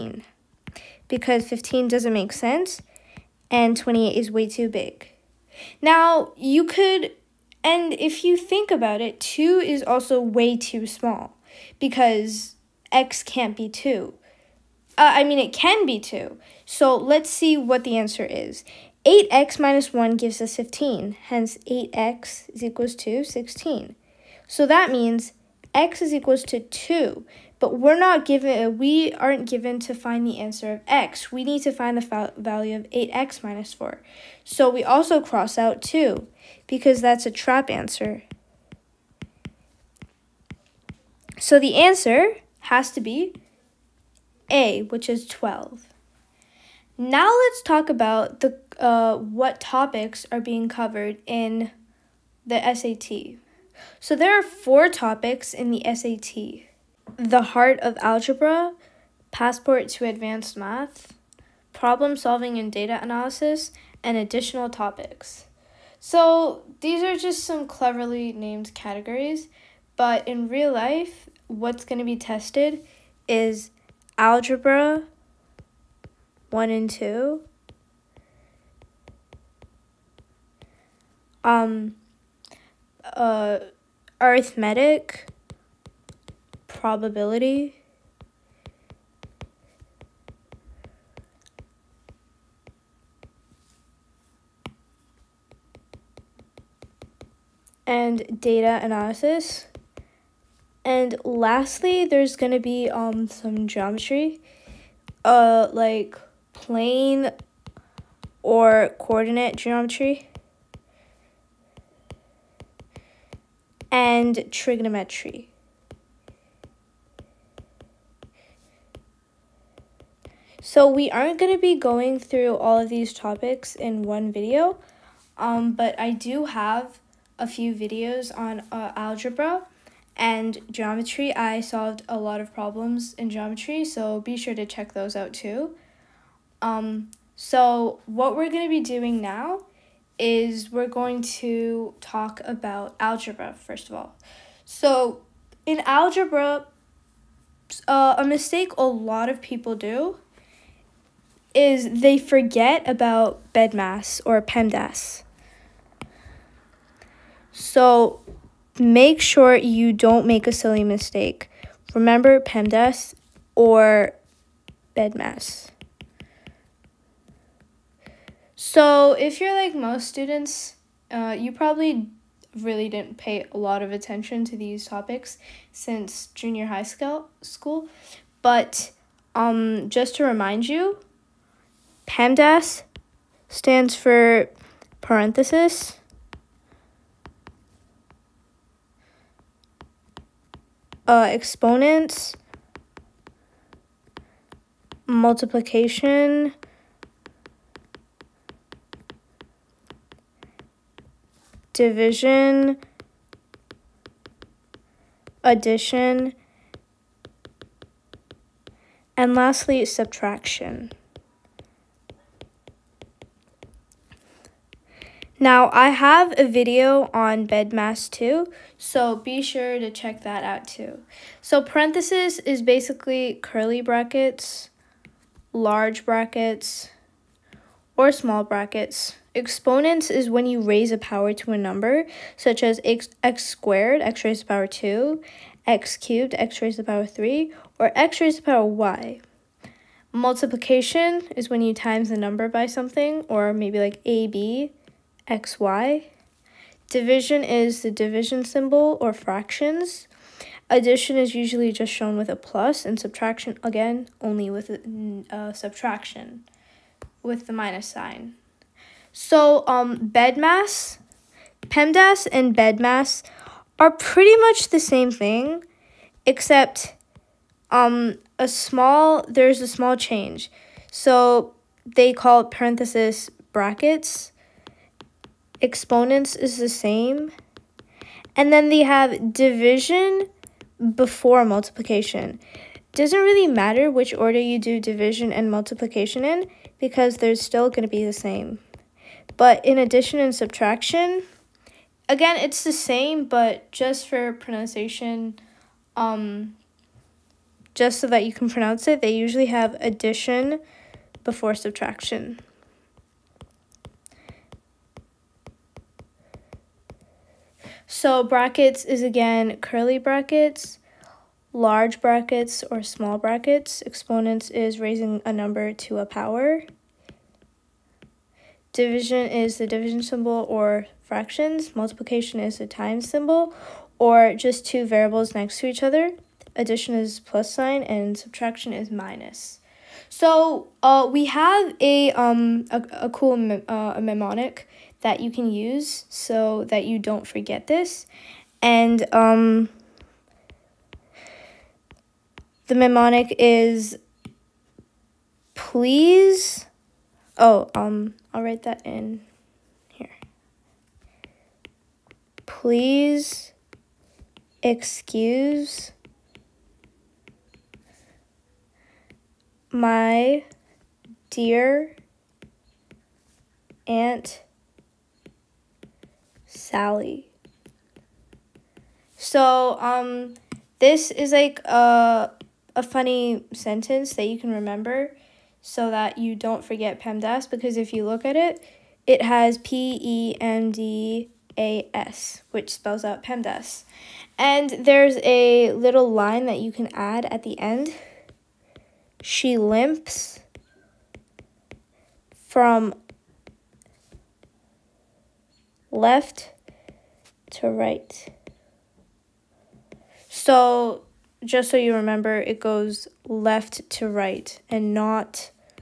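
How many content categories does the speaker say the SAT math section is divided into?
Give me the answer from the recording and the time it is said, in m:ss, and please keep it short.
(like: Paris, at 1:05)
4, at 0:54.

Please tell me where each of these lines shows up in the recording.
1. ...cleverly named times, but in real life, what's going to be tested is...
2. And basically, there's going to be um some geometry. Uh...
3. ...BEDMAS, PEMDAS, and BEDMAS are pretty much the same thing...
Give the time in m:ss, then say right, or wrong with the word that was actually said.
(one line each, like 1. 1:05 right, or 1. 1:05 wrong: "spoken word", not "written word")
1. 1:07 wrong: "categories", not "times"
2. 1:40 wrong: "lastly", not "basically"
3. 4:20 right.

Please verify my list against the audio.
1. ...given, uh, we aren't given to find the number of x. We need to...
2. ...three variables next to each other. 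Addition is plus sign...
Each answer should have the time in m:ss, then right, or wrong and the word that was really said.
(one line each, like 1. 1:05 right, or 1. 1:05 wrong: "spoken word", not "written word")
1. 0:28 wrong: "answer", not "number"
2. 5:24 wrong: "two", not "three".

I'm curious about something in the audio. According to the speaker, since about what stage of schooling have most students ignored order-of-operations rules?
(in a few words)
Junior high school.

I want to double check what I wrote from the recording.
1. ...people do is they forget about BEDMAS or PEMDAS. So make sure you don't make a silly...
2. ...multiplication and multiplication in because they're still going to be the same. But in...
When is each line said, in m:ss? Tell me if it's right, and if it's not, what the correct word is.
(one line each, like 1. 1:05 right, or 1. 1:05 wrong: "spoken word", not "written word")
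1. 2:29 right
2. 4:44 wrong: "division", not "multiplication".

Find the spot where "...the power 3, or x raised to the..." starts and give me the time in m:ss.
3:56.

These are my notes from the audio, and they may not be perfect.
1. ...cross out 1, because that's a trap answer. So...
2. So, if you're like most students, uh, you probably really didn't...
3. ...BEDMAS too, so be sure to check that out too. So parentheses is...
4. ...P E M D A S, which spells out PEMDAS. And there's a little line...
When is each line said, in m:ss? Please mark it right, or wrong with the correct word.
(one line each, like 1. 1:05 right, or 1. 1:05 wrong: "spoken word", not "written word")
1. 0:35 wrong: "2", not "1"
2. 2:48 right
3. 3:37 right
4. 6:19 right.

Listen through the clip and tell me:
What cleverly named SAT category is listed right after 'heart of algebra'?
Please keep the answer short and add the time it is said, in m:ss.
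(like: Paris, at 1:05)
Passport to advanced math, at 0:59.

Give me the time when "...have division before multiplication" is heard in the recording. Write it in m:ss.
4:38.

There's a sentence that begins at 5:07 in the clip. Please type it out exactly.
So brackets is again curly brackets, large brackets or small brackets.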